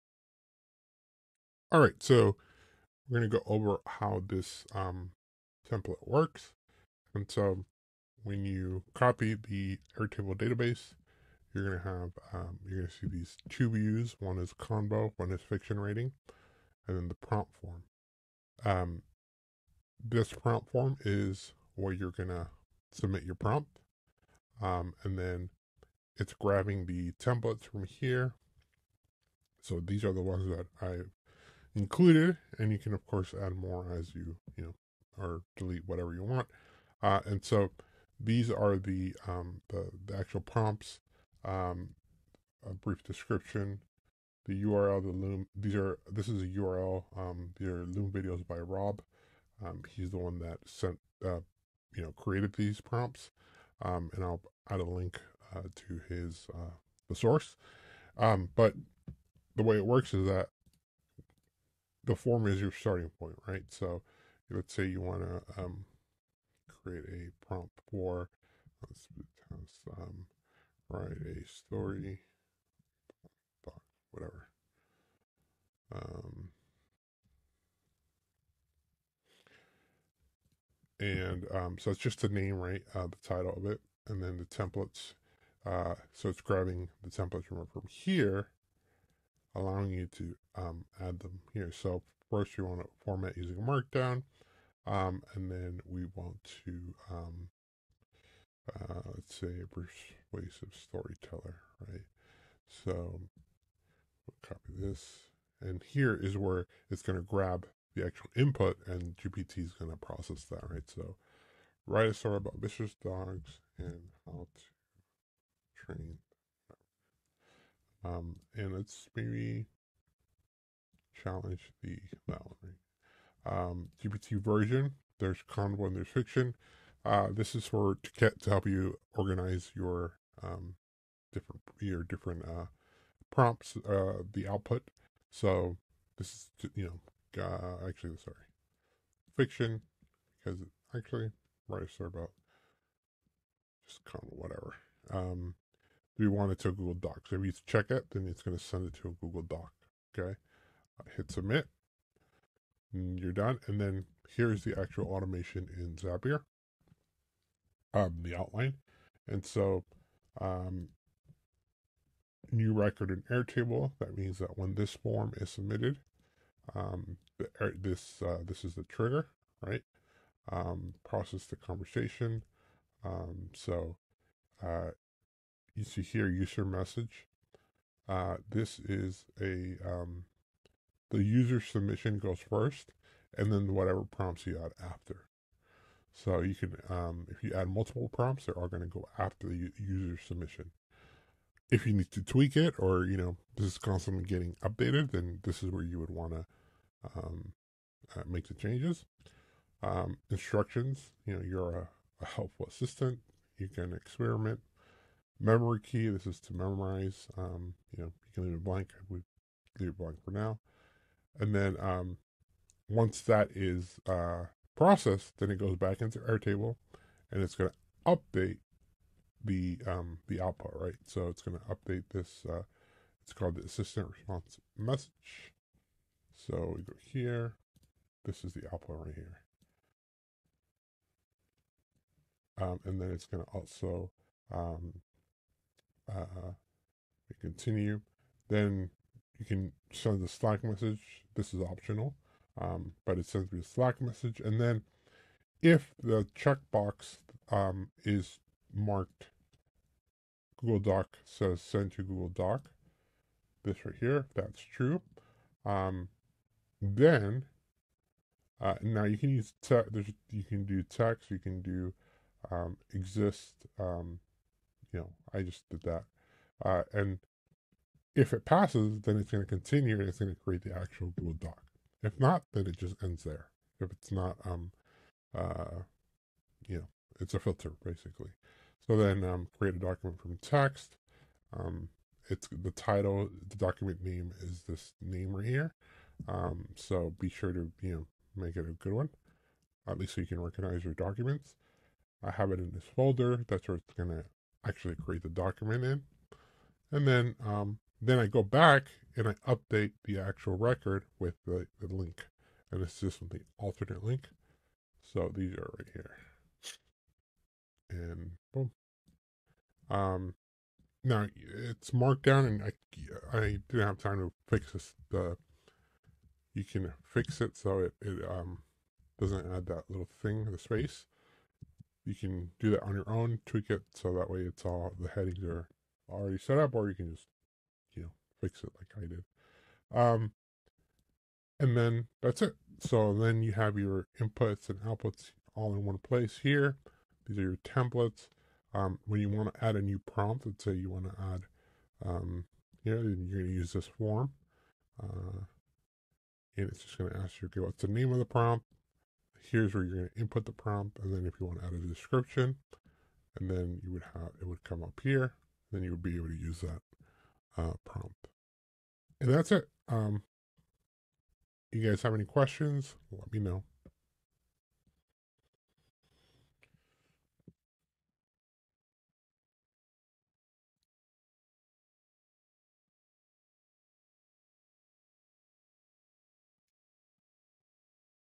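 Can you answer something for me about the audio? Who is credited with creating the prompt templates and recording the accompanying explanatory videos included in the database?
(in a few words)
Rob.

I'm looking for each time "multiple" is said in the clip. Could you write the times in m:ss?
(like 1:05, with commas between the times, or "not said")
3:07.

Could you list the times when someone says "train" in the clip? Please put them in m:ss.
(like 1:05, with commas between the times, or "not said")
1:55.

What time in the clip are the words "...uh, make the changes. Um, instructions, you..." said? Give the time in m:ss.
3:18.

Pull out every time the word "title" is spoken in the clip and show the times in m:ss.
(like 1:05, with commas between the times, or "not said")
1:23, 4:42.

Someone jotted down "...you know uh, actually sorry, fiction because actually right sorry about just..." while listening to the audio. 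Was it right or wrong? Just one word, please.
right.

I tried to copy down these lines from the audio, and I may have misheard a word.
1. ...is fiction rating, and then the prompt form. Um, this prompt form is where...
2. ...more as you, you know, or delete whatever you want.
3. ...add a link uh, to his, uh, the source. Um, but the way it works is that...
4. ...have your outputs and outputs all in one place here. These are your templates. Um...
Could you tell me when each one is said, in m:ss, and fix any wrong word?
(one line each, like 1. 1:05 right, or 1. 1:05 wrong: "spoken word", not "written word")
1. 0:15 right
2. 0:33 right
3. 0:54 right
4. 5:33 wrong: "inputs", not "outputs".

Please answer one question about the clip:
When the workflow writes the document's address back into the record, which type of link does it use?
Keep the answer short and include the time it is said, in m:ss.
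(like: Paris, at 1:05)
alternate link, at 5:03.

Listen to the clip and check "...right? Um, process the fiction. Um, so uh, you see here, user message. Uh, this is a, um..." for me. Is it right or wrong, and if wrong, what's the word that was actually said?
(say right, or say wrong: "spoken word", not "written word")
wrong: "conversation", not "fiction".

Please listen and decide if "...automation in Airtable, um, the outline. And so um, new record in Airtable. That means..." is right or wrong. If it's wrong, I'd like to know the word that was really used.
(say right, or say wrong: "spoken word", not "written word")
wrong: "Zapier", not "Airtable".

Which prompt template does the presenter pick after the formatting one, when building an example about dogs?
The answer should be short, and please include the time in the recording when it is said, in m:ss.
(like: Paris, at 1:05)
persuasive storyteller, at 1:39.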